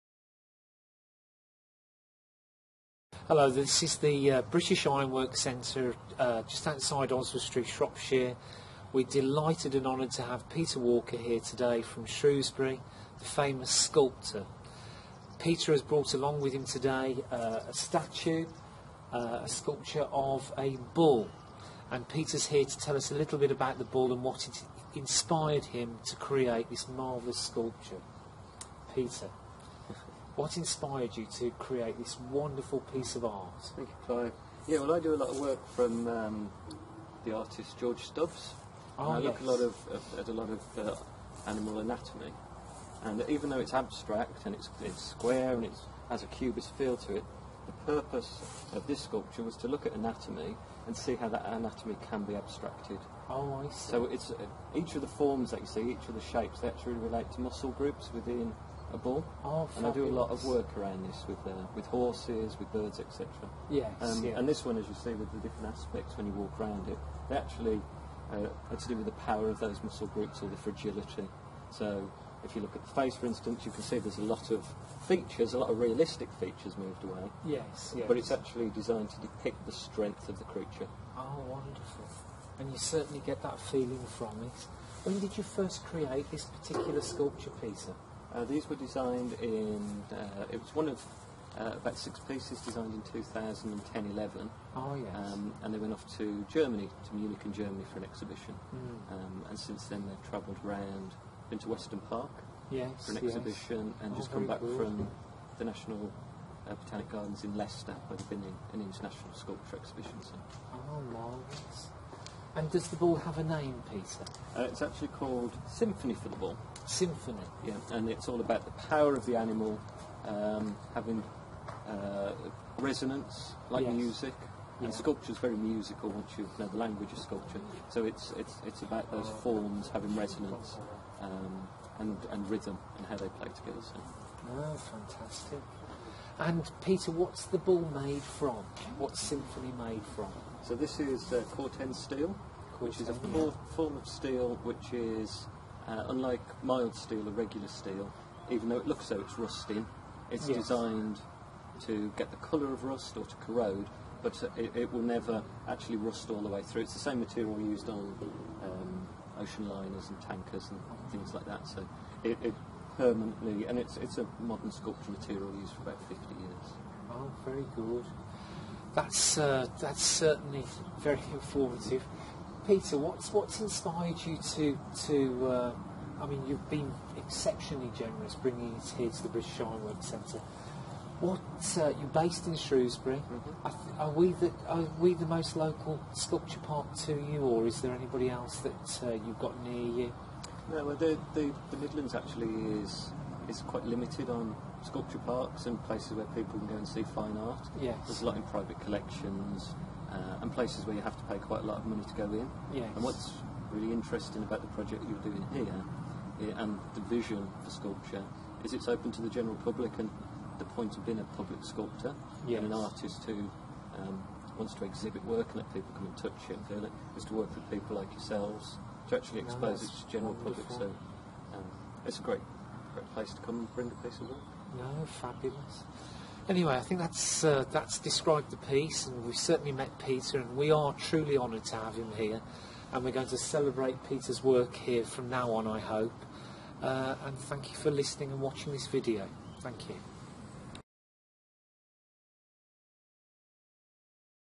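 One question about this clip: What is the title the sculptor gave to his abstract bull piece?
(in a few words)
Symphony for the Bull.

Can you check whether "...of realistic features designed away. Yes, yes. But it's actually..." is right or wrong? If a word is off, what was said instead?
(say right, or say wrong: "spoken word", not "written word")
wrong: "moved", not "designed".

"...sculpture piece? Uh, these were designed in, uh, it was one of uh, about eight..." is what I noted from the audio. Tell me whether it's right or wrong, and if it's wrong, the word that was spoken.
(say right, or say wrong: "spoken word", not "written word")
wrong: "six", not "eight".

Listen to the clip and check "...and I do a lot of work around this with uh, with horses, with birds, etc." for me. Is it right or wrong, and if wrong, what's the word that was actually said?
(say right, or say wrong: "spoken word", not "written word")
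right.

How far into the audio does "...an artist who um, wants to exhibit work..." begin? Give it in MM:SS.
03:32.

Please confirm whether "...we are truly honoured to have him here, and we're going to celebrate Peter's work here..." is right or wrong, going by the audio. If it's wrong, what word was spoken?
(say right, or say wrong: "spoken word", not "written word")
right.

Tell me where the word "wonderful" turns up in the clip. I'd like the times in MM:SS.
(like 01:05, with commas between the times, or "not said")
00:32, 01:21.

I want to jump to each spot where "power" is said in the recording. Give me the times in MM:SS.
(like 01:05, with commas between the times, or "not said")
01:09, 01:58.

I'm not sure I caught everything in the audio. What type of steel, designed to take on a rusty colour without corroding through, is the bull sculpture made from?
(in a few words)
Corten steel.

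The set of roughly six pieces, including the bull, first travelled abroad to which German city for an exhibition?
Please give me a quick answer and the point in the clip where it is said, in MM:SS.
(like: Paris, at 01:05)
Munich, at 01:37.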